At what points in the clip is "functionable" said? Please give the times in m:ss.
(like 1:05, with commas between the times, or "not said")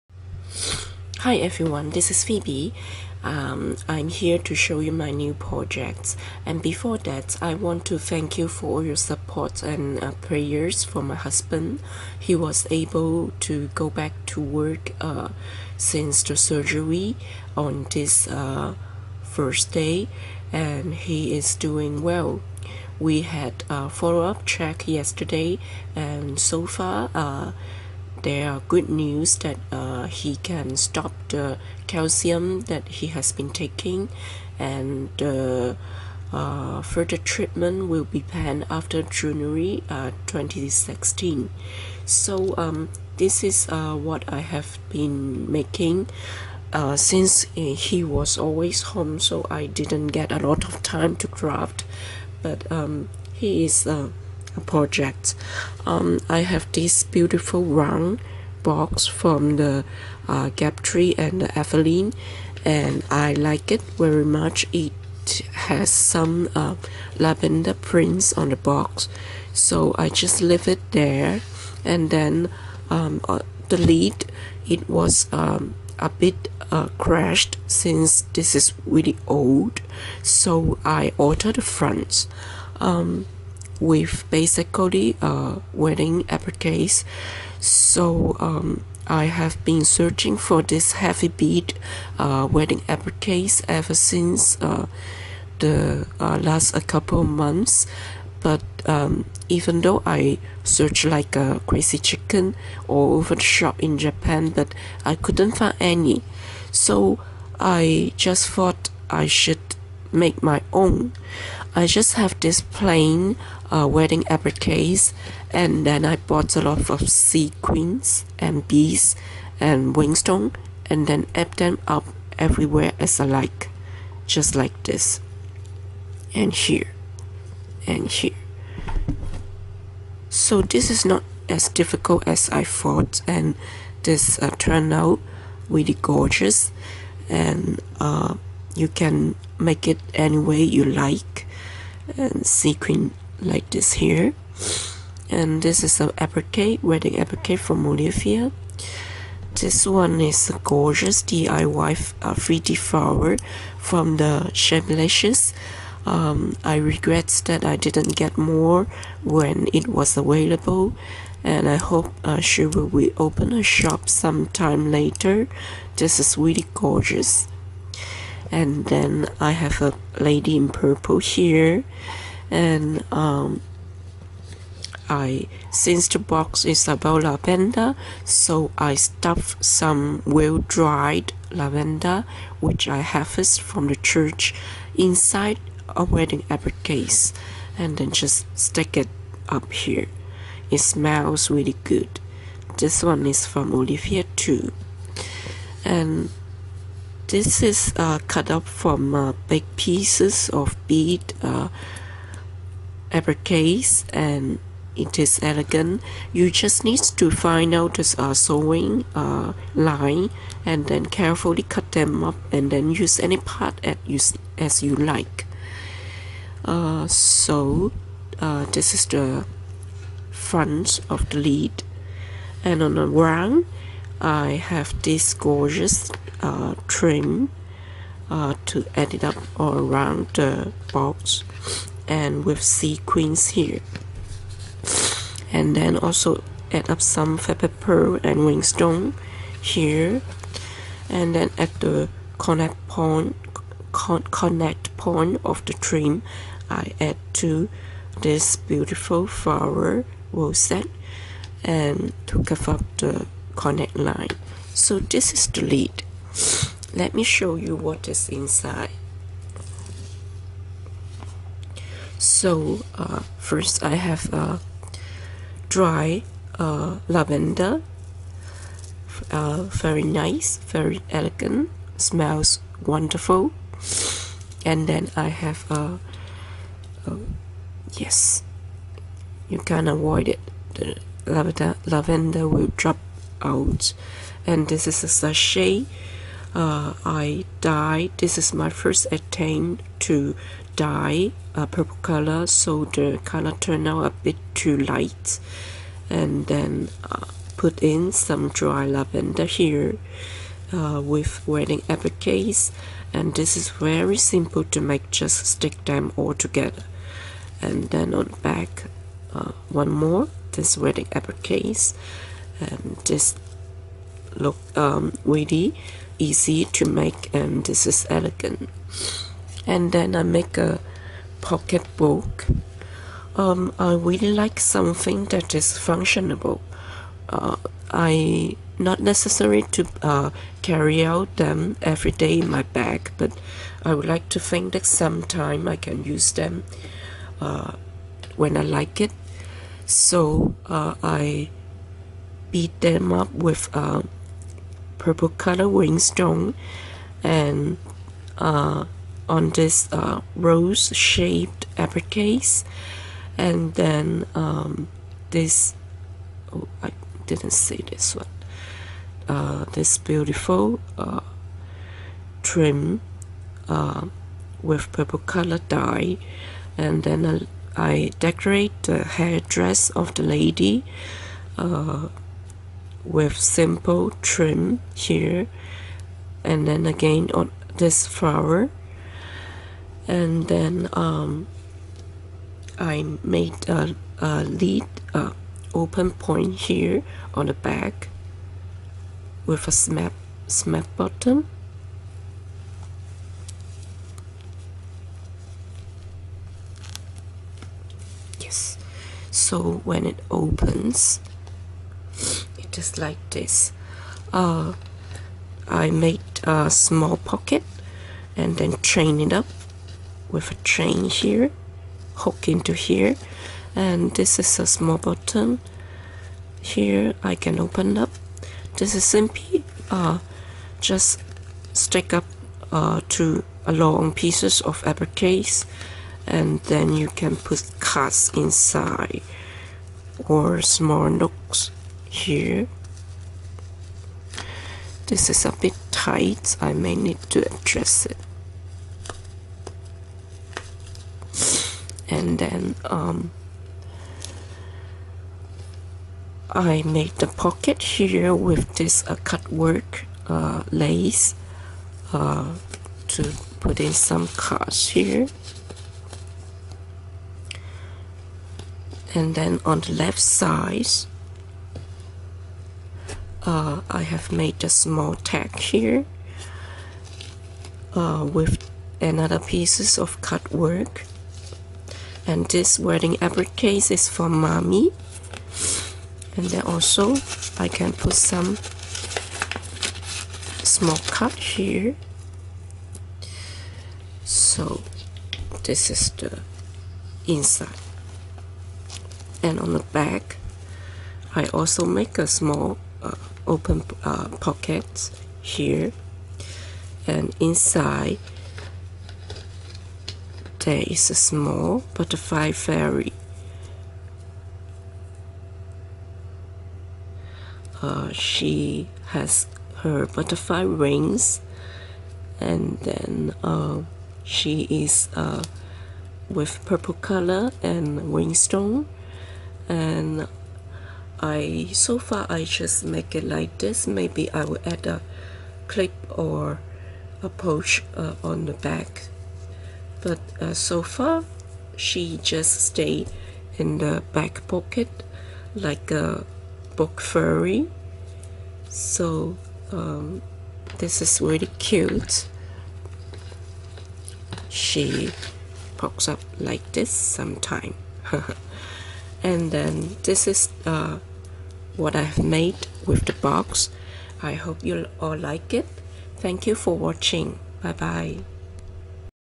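5:25.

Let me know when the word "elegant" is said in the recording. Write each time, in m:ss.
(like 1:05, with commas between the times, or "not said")
3:25, 4:31, 5:18.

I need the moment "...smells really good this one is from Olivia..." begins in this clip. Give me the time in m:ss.
3:10.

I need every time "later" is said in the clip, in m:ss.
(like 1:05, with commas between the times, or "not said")
2:44.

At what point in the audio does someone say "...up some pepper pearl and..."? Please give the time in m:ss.
3:56.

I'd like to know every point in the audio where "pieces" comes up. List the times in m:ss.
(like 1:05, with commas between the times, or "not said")
3:19, 7:04, 7:49.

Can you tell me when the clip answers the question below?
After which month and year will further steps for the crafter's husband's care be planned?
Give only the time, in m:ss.
0:39.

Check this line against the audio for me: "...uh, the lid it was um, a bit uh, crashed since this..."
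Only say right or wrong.
right.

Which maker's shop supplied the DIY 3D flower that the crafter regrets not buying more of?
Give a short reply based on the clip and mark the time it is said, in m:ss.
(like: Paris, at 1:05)
Shamelicious, at 2:34.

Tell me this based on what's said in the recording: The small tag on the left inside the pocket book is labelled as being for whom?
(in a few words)
mommy.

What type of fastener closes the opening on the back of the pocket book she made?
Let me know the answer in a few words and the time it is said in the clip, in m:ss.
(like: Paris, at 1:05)
snap button, at 6:29.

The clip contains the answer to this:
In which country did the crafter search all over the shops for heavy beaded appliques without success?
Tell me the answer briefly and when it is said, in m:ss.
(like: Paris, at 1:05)
Japan, at 1:43.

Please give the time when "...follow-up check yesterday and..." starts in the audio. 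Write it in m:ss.
0:23.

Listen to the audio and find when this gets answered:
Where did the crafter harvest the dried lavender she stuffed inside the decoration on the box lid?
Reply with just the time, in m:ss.
3:03.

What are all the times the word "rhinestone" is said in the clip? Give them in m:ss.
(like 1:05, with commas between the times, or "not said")
1:59, 8:38.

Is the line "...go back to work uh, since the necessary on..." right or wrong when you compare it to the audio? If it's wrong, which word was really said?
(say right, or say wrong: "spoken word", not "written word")
wrong: "surgery", not "necessary".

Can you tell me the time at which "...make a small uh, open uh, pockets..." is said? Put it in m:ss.
8:11.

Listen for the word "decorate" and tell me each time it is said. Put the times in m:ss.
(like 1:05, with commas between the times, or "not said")
6:08.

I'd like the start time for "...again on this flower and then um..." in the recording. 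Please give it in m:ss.
6:16.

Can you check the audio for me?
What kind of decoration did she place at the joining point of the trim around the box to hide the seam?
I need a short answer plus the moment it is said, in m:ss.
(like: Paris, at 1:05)
flower rosette, at 4:09.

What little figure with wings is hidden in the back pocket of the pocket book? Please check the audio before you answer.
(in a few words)
butterfly fairy.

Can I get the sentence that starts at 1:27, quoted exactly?
So um, I have been searching for this heavy bead uh, wedding appliques ever since uh, the uh, last a couple months.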